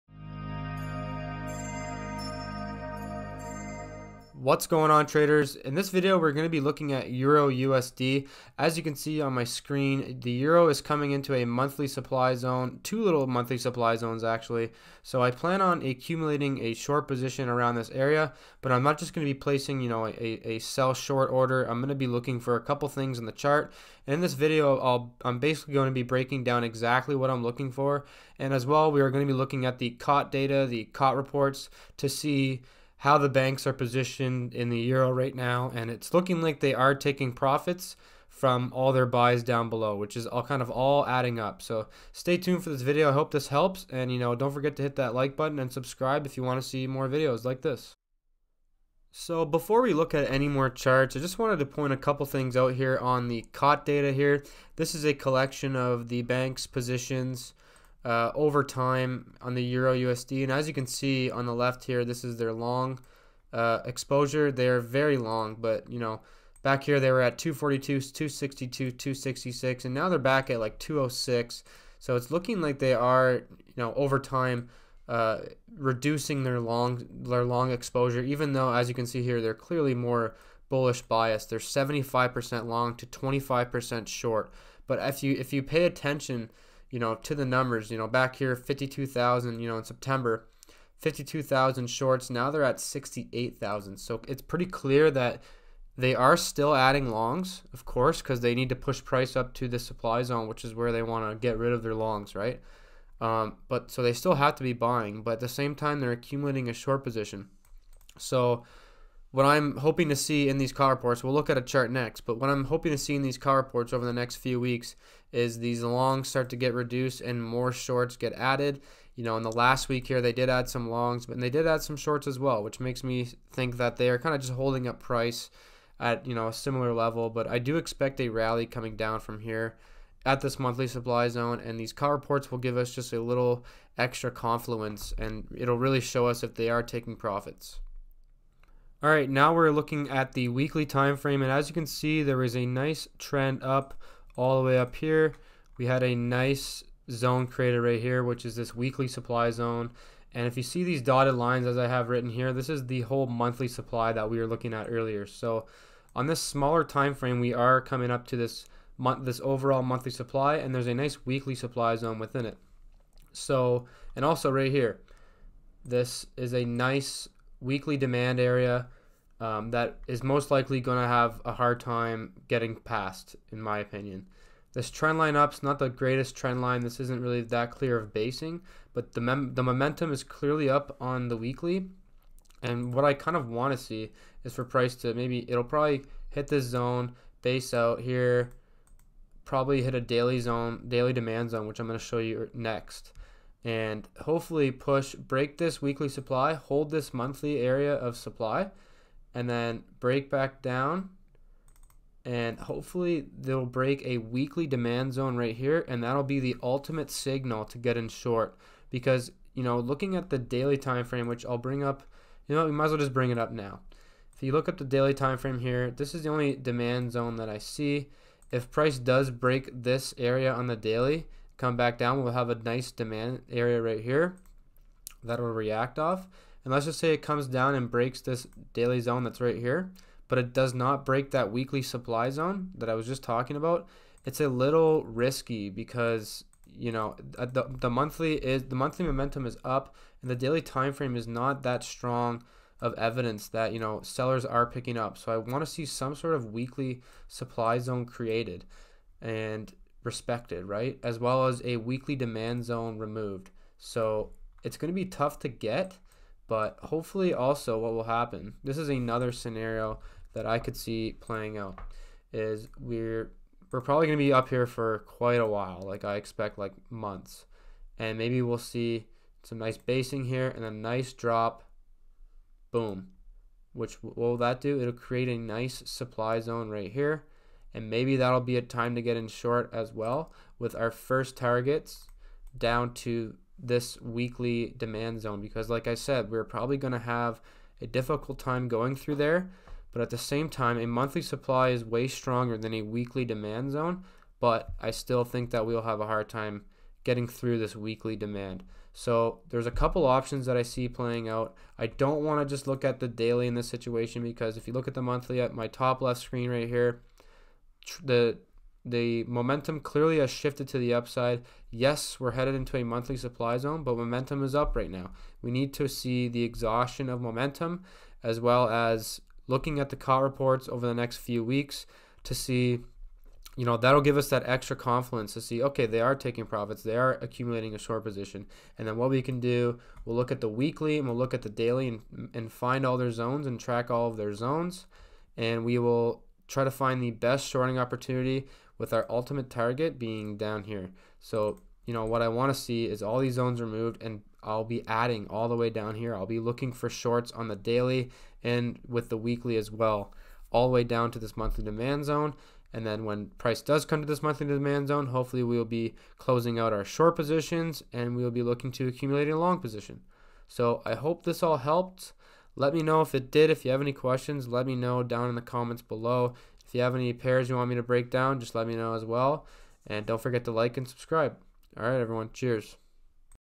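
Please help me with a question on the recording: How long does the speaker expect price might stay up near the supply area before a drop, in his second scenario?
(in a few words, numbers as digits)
months.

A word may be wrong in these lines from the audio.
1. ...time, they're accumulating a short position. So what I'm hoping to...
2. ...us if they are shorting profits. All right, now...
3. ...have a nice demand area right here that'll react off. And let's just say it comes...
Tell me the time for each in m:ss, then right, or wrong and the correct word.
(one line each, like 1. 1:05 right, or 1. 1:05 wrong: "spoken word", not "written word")
1. 1:45 right
2. 2:16 wrong: "taking", not "shorting"
3. 3:42 right.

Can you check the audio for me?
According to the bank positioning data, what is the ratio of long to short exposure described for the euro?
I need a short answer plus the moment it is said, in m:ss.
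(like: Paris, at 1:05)
75% long to 25% short, at 1:21.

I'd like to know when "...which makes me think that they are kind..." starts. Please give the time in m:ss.
2:02.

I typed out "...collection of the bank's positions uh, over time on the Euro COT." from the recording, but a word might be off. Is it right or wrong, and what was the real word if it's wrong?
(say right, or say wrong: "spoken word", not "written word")
wrong: "USD", not "COT".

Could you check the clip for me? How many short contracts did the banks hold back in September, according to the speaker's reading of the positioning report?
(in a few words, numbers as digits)
52,000.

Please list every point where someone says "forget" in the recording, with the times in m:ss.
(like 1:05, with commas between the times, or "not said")
0:44, 6:10.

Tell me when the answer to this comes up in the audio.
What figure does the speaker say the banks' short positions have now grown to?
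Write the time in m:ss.
1:32.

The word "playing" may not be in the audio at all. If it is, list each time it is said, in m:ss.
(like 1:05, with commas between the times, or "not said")
4:21, 5:00.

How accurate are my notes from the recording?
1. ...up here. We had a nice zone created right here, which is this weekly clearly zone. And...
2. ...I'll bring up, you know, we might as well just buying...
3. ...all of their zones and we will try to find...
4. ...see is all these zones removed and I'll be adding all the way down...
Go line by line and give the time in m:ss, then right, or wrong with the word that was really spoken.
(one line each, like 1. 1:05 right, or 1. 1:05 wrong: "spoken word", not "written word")
1. 2:24 wrong: "supply", not "clearly"
2. 3:31 wrong: "bring", not "buying"
3. 5:33 right
4. 5:42 right.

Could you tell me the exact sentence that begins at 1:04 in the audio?
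They're very long, but you know, back here they were at 242, 262, 266, and now they're back at like 206.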